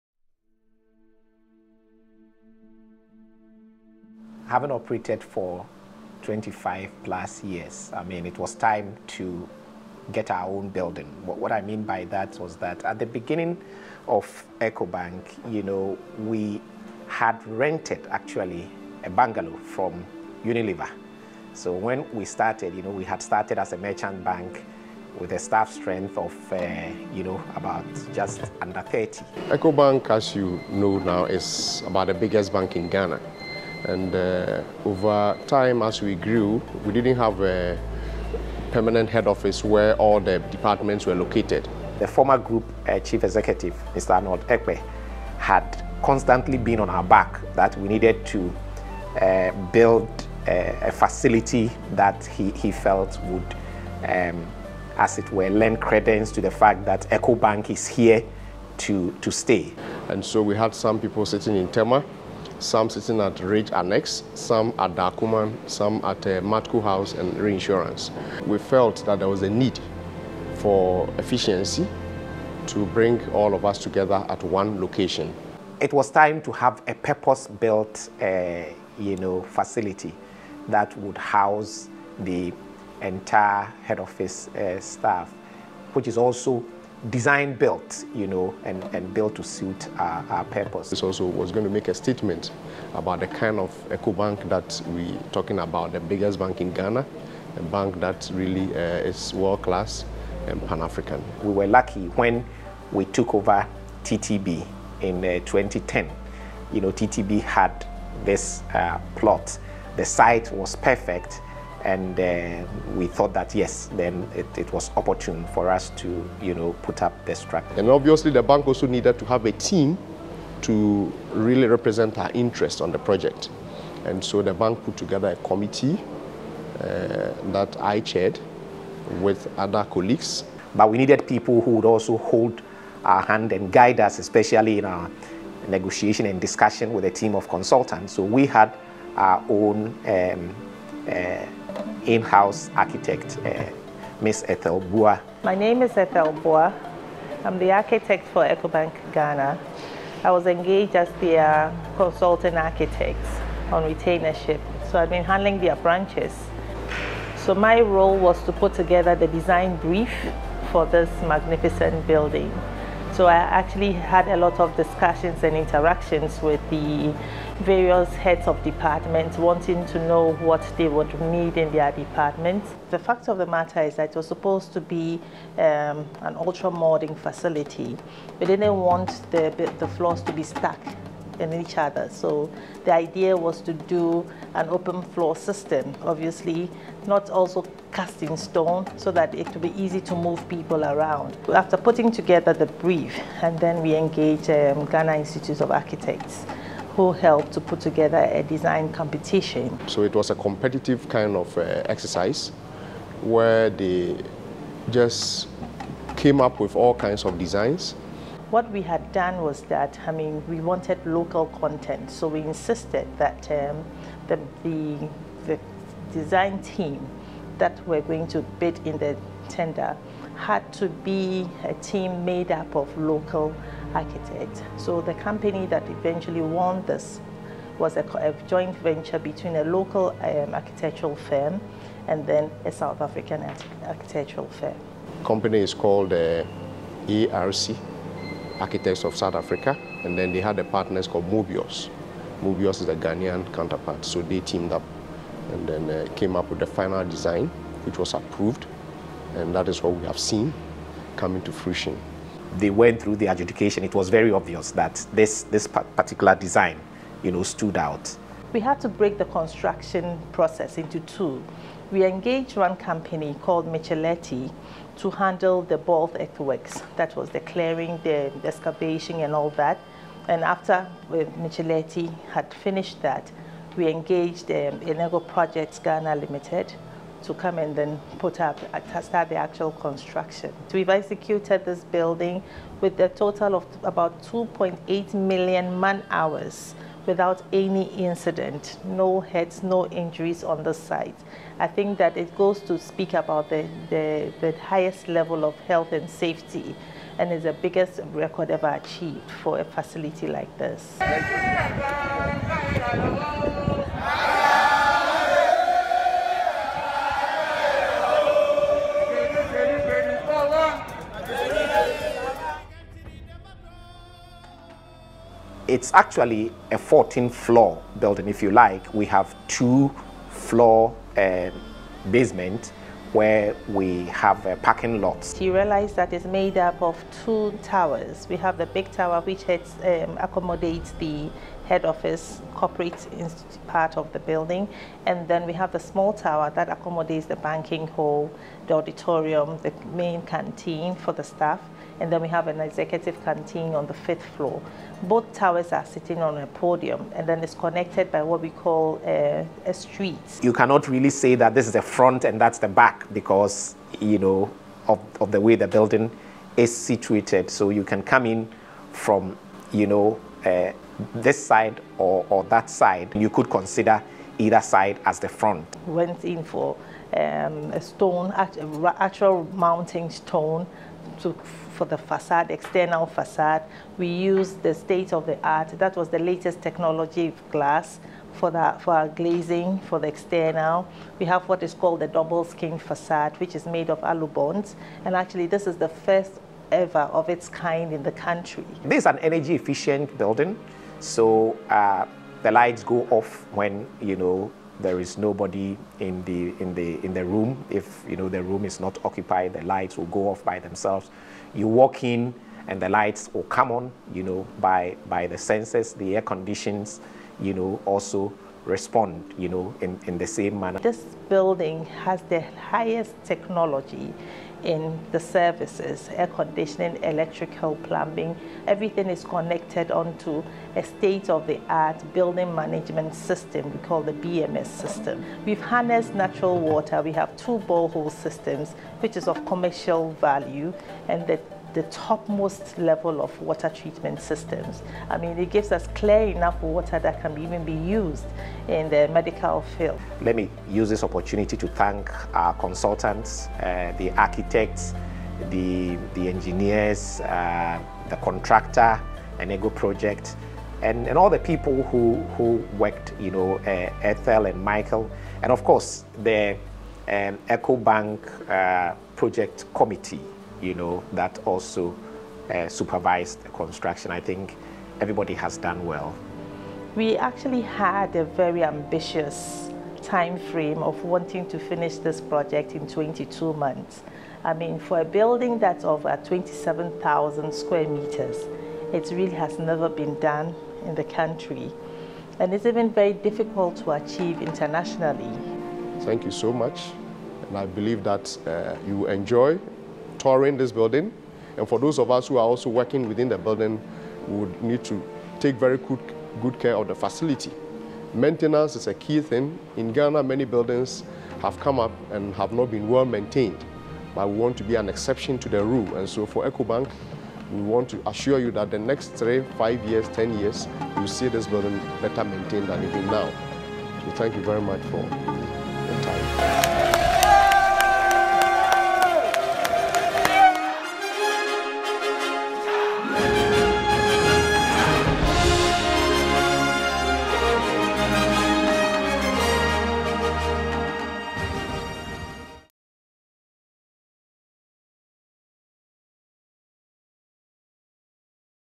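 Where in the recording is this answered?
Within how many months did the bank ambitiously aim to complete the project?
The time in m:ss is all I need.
7:52.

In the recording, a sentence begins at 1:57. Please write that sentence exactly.
And obviously the bank also needed to have a team to really represent our interest on the project.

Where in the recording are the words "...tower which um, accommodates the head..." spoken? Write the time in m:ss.
5:28.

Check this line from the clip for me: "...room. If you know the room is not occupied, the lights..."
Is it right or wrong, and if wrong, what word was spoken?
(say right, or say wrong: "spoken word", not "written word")
right.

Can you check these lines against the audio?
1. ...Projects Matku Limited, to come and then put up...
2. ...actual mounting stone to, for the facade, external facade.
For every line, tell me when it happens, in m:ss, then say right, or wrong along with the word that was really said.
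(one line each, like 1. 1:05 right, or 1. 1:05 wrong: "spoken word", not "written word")
1. 4:35 wrong: "Ghana", not "Matku"
2. 6:08 right.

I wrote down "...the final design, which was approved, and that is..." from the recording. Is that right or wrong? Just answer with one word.
right.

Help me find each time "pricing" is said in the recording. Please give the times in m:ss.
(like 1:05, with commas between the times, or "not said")
not said.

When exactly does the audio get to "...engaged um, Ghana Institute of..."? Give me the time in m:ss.
3:13.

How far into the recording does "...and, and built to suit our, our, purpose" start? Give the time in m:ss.
1:28.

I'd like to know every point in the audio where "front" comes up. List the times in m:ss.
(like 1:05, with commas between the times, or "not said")
5:51, 6:05.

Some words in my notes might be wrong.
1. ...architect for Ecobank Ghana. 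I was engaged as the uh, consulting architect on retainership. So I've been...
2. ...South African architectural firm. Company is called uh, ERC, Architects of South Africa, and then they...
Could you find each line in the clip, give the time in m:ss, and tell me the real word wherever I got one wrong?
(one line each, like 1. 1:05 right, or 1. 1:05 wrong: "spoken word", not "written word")
1. 2:27 right
2. 3:52 right.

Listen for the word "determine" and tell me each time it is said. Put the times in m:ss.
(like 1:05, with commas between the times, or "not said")
not said.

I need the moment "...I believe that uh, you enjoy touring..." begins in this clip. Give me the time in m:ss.
8:07.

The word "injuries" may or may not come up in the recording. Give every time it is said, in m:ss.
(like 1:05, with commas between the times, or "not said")
4:49.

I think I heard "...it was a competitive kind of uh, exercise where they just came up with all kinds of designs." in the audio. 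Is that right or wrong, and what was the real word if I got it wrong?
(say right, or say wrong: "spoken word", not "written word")
right.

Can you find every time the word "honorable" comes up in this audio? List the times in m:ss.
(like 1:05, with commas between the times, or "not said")
not said.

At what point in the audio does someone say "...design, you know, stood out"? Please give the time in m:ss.
4:16.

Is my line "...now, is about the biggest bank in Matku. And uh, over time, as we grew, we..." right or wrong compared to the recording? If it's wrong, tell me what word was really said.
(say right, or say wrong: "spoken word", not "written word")
wrong: "Ghana", not "Matku".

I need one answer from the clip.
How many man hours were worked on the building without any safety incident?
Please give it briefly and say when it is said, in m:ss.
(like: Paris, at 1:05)
2.8 million, at 4:44.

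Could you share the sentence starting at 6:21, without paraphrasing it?
We have what is called the double skin facade, which is made of alu bonds.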